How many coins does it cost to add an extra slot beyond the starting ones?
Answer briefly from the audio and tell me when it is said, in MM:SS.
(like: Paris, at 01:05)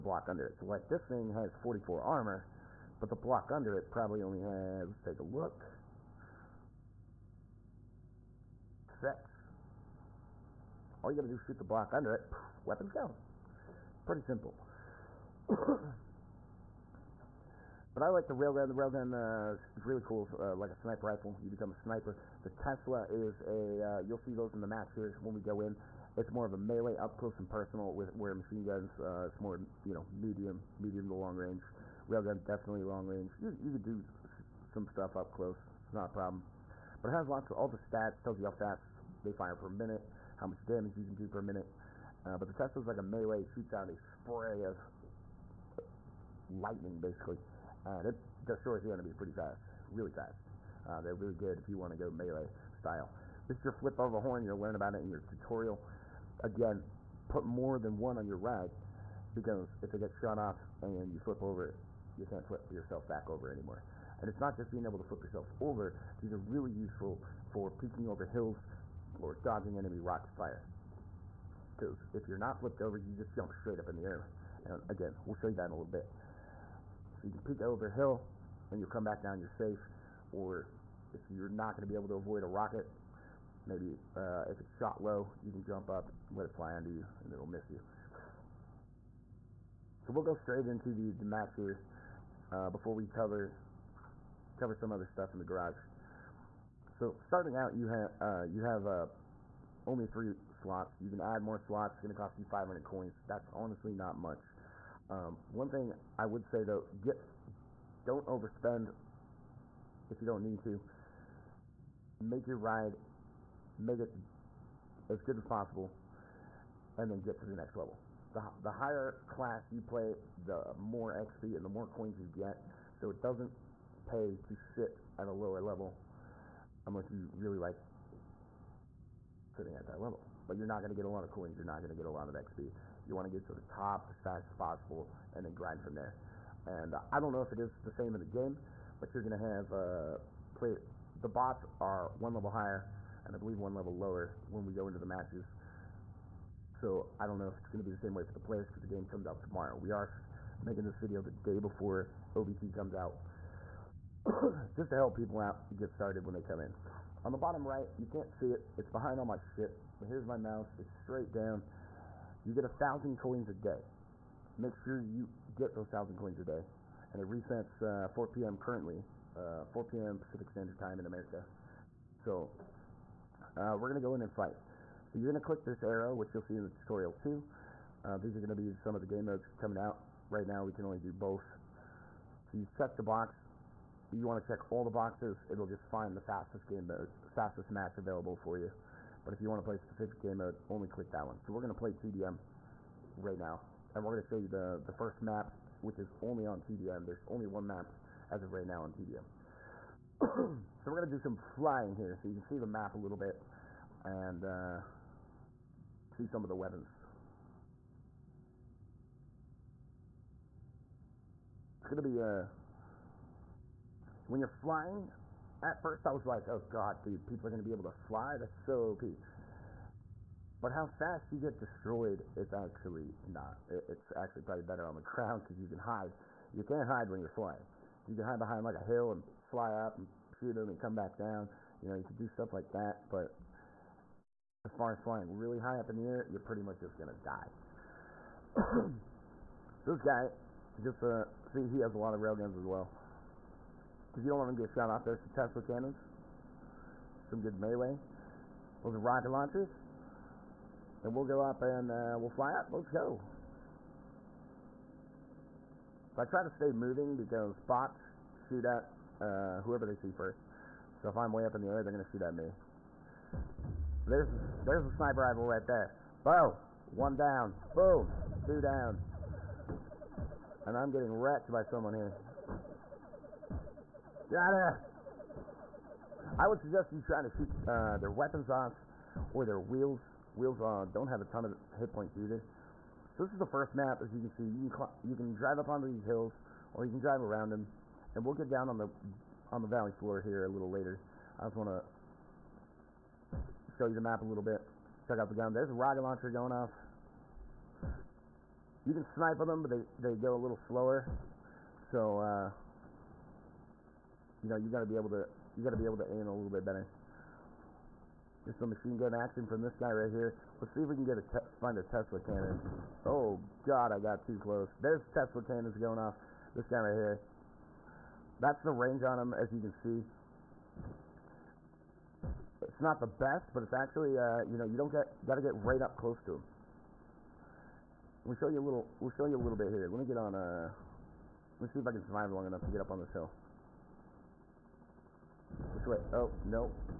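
500, at 01:42.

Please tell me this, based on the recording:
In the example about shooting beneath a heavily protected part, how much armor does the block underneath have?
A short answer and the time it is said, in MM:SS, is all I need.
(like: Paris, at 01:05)
6, at 00:09.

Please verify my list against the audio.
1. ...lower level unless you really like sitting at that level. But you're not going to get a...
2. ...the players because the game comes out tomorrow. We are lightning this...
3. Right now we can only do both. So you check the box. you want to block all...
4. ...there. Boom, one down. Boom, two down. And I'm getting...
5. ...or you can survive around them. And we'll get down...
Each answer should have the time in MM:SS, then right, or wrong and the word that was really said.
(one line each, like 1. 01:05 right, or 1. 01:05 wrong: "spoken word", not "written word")
1. 02:05 right
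2. 02:28 wrong: "making", not "lightning"
3. 03:00 wrong: "check", not "block"
4. 04:25 right
5. 04:46 wrong: "drive", not "survive".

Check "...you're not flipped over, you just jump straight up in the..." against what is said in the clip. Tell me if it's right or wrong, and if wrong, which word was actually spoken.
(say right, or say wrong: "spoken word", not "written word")
right.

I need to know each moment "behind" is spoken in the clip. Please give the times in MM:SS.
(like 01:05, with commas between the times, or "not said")
02:38, 03:48.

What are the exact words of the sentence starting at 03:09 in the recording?
But if you want to play a specific game mode, only click that one.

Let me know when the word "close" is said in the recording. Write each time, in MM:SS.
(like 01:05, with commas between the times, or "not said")
00:27, 00:35, 05:14, 05:25.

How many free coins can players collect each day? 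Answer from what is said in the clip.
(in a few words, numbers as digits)
1000.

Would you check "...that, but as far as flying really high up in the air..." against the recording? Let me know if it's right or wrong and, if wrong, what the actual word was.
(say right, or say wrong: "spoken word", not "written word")
right.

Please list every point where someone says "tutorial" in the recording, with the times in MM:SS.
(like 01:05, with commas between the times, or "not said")
00:55, 02:56.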